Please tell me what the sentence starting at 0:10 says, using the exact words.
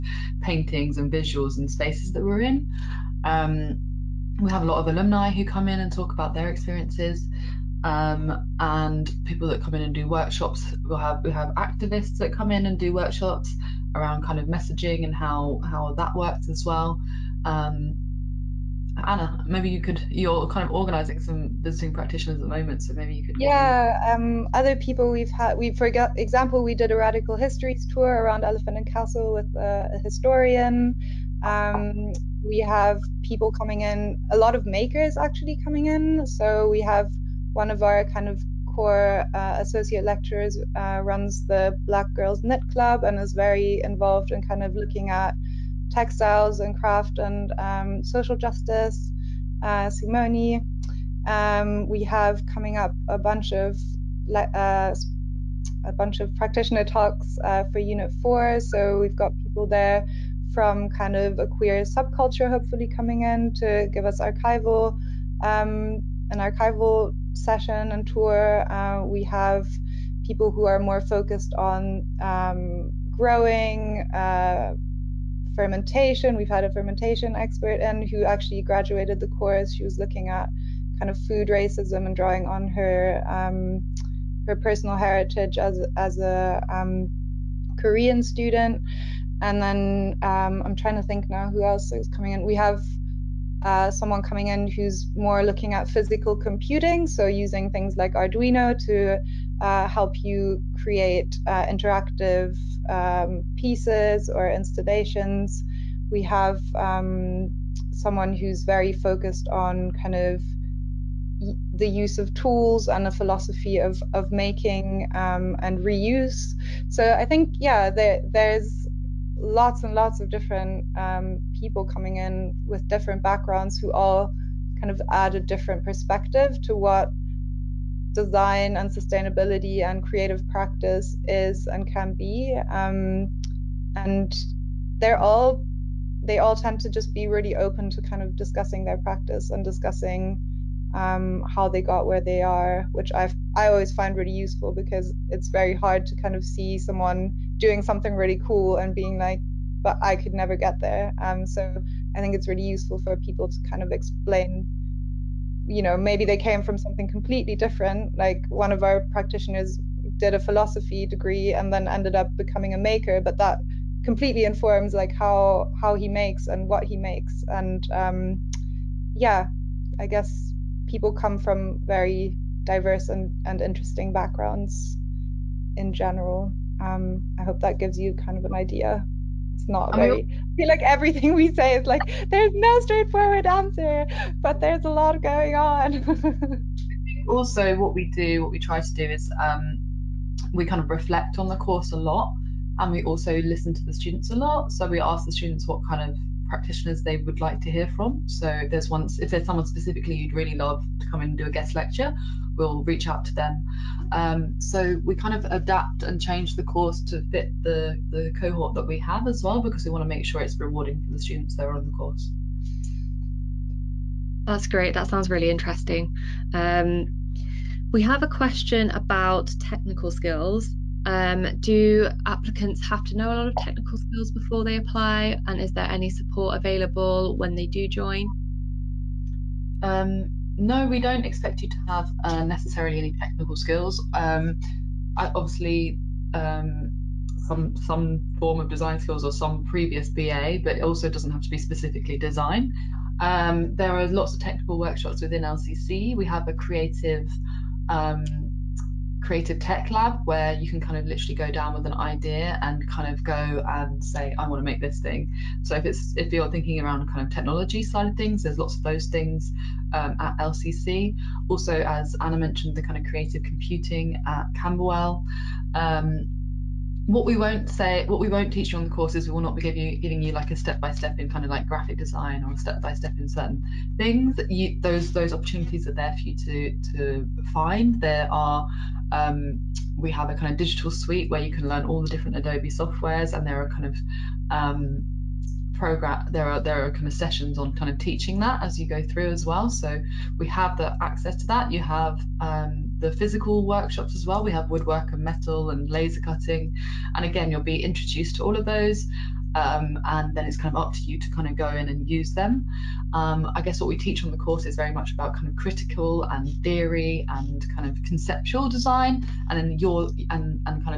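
We'll have we have activists that come in and do workshops around kind of messaging and how how that works as well.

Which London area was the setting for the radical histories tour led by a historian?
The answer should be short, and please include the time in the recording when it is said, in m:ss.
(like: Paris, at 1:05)
Elephant and Castle, at 0:28.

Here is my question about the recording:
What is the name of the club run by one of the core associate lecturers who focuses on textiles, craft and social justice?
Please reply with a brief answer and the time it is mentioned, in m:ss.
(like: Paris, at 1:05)
Black Girls Knit Club, at 0:41.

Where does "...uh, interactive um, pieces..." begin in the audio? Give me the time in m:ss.
1:41.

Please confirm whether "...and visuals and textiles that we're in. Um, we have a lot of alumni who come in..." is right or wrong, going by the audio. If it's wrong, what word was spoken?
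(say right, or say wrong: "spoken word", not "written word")
wrong: "spaces", not "textiles".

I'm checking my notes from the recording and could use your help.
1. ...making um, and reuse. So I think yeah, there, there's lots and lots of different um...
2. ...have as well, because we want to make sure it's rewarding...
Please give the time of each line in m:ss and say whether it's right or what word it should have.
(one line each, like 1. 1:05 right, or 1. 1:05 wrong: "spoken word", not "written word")
1. 1:54 right
2. 3:28 right.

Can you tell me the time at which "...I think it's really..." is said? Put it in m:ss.
2:32.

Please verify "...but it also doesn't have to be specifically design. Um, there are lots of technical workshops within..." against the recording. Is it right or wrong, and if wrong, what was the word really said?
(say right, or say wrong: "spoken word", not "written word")
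right.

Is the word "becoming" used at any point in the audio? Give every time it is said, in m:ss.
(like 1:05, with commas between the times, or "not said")
2:42.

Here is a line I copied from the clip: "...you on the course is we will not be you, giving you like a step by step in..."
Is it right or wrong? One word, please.
right.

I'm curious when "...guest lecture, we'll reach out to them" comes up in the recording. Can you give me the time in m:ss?
3:21.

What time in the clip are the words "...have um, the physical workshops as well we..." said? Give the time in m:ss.
4:51.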